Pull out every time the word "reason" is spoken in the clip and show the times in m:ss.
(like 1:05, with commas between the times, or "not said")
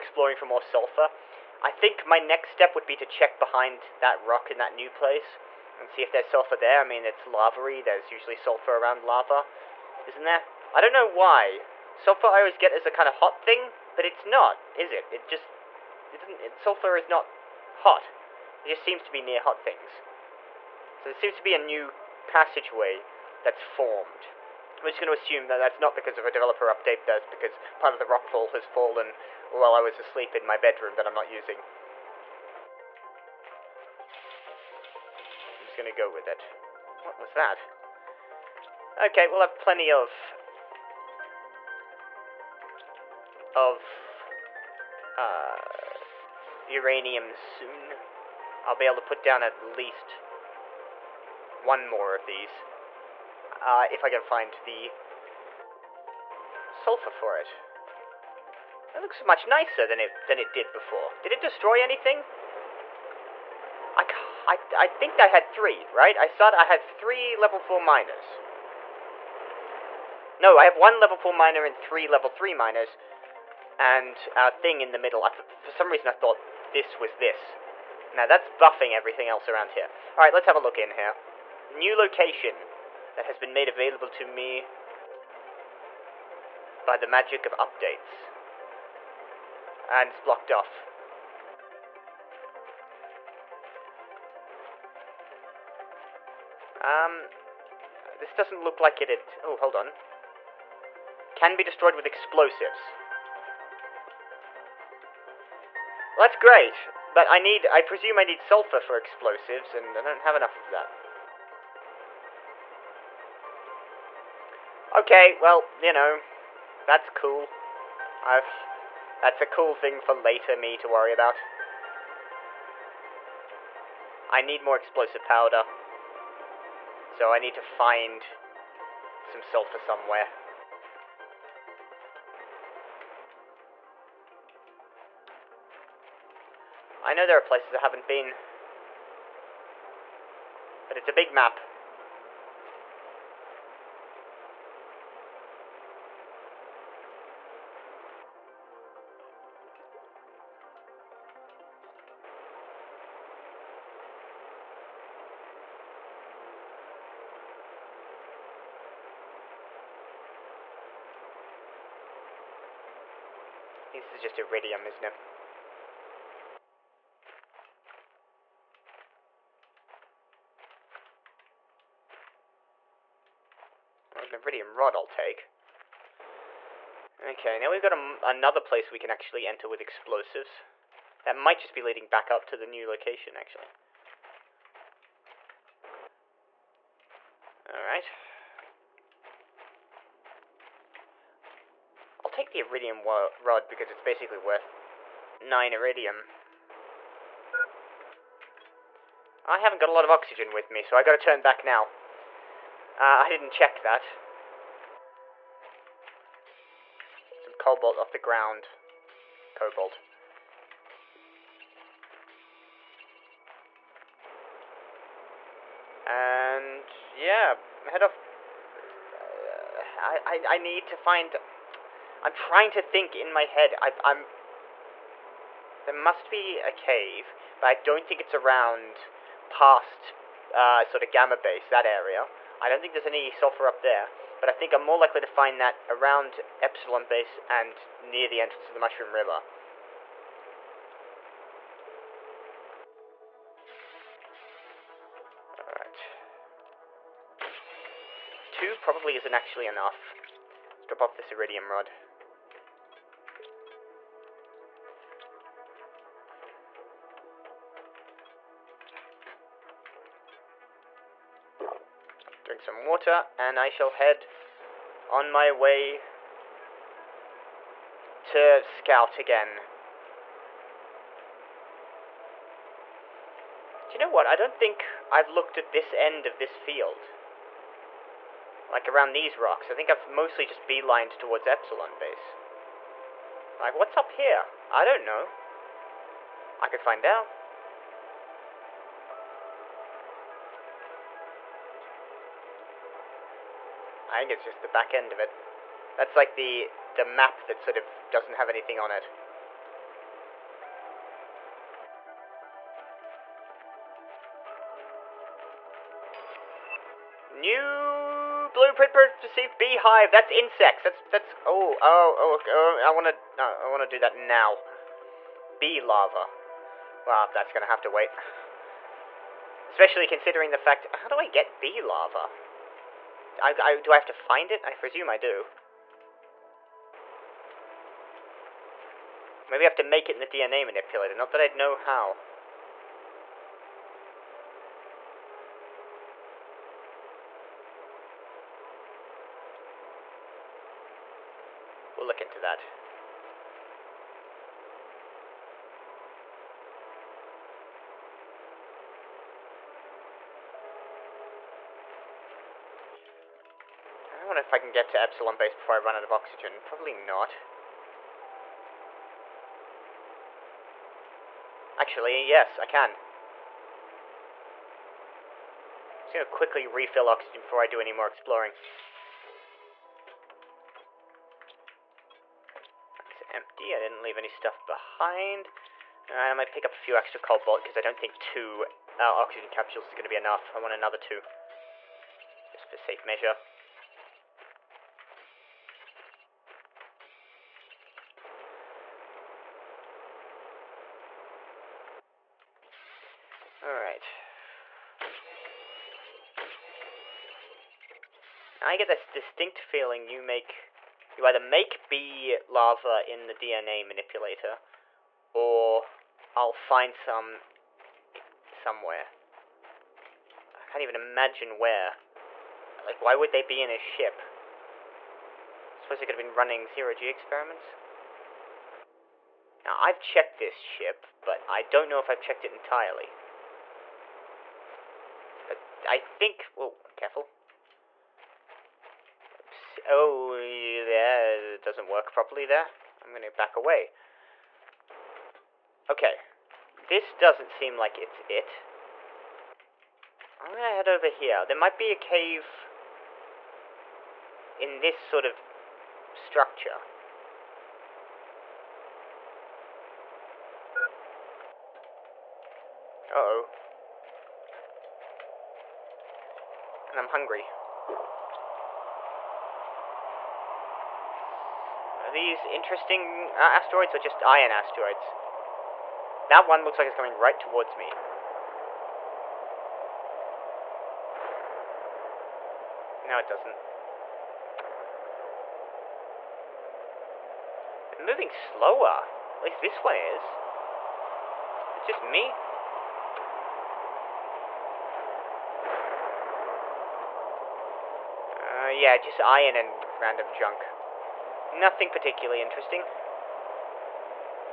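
1:15.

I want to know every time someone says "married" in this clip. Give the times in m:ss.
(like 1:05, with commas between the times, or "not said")
not said.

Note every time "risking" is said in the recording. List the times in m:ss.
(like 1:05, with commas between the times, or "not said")
not said.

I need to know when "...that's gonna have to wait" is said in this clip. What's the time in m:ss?
5:17.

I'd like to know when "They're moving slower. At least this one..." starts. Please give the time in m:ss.
7:57.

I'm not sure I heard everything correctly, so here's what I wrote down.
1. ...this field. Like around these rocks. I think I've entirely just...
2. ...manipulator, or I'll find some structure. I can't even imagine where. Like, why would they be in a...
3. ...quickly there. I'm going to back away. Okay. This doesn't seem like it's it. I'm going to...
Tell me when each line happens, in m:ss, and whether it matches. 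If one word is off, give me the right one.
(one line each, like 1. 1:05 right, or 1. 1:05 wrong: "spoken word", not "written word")
1. 4:36 wrong: "mostly", not "entirely"
2. 6:43 wrong: "somewhere", not "structure"
3. 7:12 wrong: "properly", not "quickly".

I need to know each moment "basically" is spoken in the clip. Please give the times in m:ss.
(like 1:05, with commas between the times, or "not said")
3:14.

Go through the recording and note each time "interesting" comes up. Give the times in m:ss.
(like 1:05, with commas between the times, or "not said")
7:42, 8:12.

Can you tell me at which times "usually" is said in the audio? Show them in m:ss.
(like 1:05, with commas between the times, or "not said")
0:08.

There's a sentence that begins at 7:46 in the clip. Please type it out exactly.
That one looks like it's coming right towards me.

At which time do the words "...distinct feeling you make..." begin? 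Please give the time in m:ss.
6:39.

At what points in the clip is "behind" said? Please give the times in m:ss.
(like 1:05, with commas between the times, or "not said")
0:03, 6:14.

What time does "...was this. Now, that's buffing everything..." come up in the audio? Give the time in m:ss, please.
1:16.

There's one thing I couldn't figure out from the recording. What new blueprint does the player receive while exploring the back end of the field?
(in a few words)
Beehive.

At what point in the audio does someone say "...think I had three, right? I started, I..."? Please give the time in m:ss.
1:04.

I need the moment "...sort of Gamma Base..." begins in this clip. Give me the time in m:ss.
3:50.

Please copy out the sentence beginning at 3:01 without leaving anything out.
That might just be leading back up to the new location, actually.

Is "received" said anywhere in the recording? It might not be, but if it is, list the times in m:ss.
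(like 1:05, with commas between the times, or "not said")
5:09.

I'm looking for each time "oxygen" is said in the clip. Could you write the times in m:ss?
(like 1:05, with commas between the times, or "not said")
3:20, 5:56, 6:07, 6:19.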